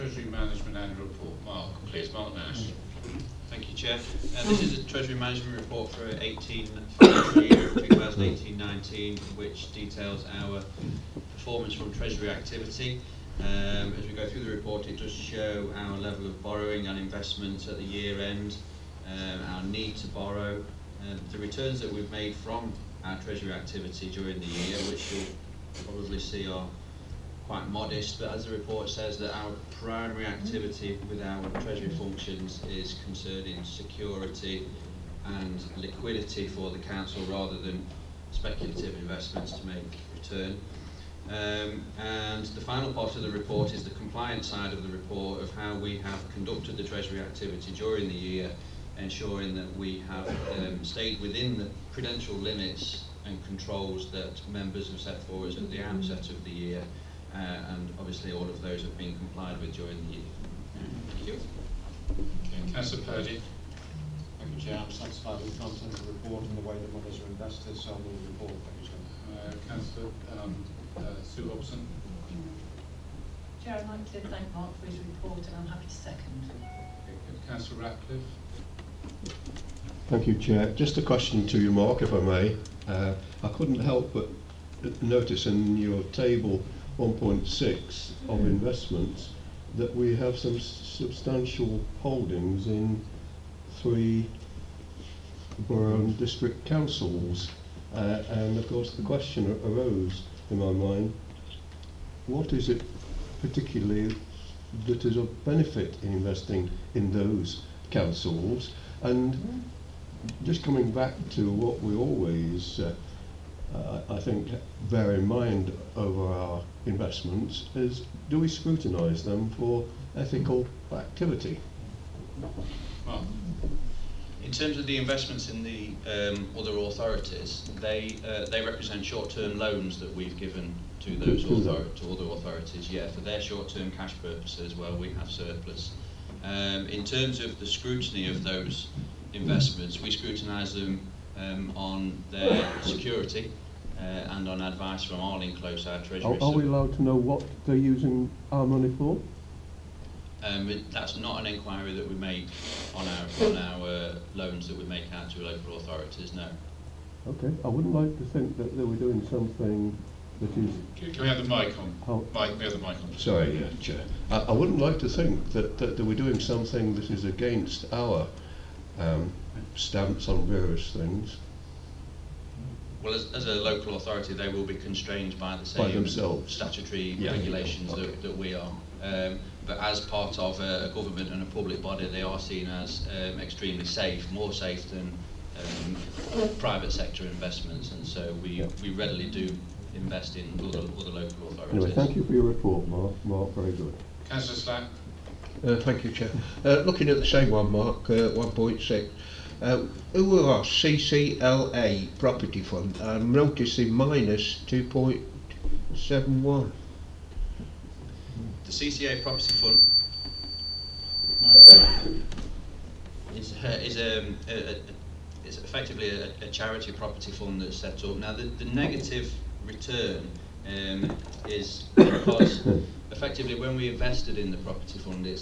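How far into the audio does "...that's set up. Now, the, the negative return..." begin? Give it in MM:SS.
03:37.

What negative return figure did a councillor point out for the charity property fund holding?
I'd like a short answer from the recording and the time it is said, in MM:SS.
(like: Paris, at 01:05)
-2.71, at 03:23.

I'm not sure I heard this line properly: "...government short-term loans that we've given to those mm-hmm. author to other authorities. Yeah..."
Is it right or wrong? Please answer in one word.
wrong.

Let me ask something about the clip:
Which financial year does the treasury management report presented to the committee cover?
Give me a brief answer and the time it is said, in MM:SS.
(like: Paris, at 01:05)
2018-19, at 00:06.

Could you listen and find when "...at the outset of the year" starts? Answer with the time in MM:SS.
00:55.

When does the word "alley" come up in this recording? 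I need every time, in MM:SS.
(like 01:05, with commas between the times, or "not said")
not said.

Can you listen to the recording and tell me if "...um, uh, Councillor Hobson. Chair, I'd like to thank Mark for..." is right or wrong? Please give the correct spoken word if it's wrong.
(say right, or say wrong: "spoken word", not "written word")
wrong: "Sue", not "Councillor".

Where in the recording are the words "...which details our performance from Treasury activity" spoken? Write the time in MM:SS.
00:09.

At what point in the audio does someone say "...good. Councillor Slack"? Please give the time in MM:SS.
03:13.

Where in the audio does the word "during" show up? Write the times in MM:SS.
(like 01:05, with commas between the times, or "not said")
00:24, 00:47, 00:59.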